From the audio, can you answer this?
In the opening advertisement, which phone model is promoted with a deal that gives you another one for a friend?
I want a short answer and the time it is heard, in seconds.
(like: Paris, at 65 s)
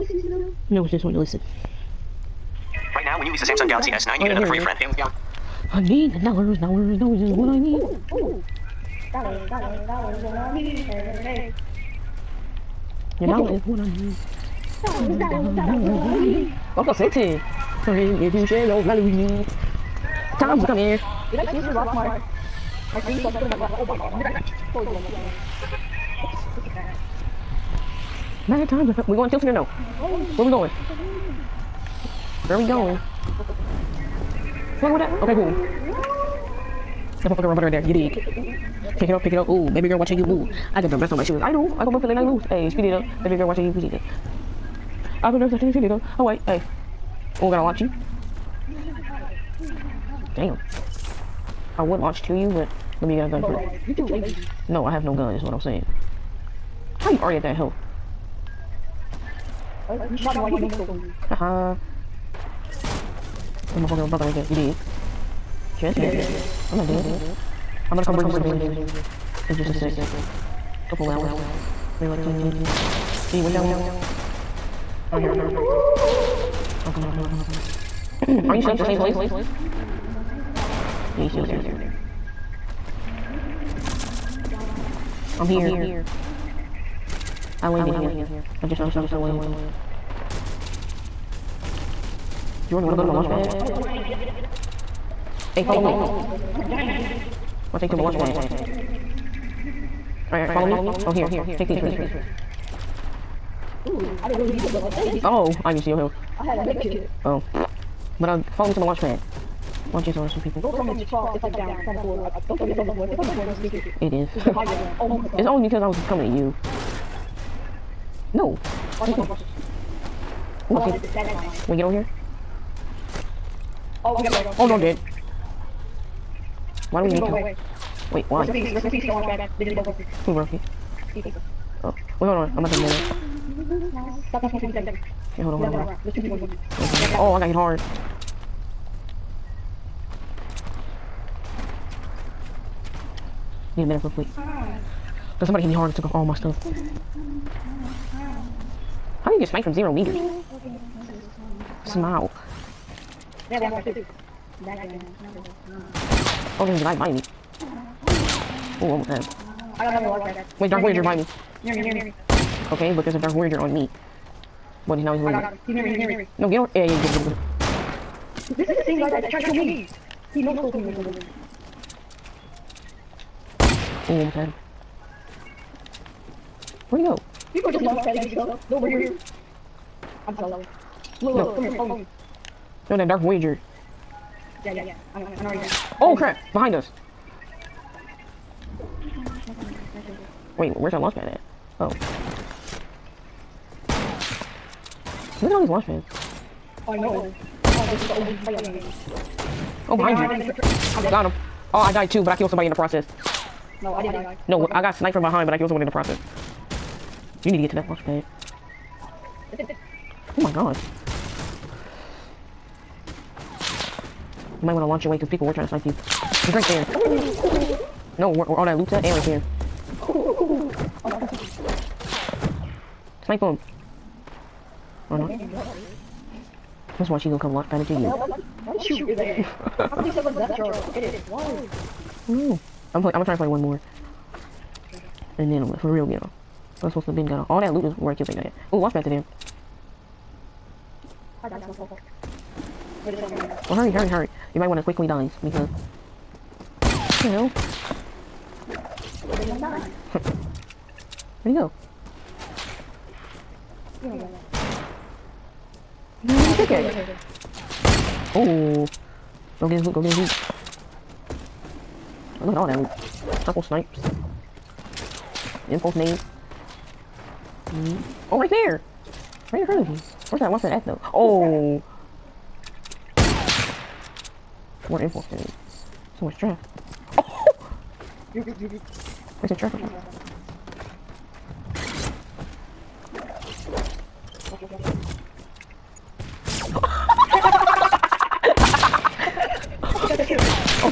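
Samsung Galaxy S9, at 3 s.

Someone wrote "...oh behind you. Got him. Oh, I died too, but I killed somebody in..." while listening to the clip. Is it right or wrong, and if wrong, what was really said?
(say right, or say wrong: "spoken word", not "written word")
right.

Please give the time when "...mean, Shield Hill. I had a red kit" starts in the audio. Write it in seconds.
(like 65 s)
105 s.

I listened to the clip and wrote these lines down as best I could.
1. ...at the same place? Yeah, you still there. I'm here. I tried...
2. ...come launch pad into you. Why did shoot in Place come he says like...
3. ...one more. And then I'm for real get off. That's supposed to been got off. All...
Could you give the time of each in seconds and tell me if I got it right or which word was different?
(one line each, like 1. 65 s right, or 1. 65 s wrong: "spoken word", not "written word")
1. 78 s wrong: "landed", not "tried"
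2. 227 s wrong: "How", not "Place"
3. 233 s right.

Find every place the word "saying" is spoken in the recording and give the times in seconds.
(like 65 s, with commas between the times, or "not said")
55 s.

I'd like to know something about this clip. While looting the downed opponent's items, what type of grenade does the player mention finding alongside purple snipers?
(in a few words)
Impulse nade.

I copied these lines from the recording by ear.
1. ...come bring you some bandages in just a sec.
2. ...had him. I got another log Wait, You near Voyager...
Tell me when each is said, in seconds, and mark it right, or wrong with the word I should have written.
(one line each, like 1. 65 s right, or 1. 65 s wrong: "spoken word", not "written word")
1. 68 s right
2. 159 s wrong: "Dark", not "You".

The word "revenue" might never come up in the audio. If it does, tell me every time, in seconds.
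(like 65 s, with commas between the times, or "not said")
not said.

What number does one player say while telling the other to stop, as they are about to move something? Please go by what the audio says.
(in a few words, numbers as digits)
157.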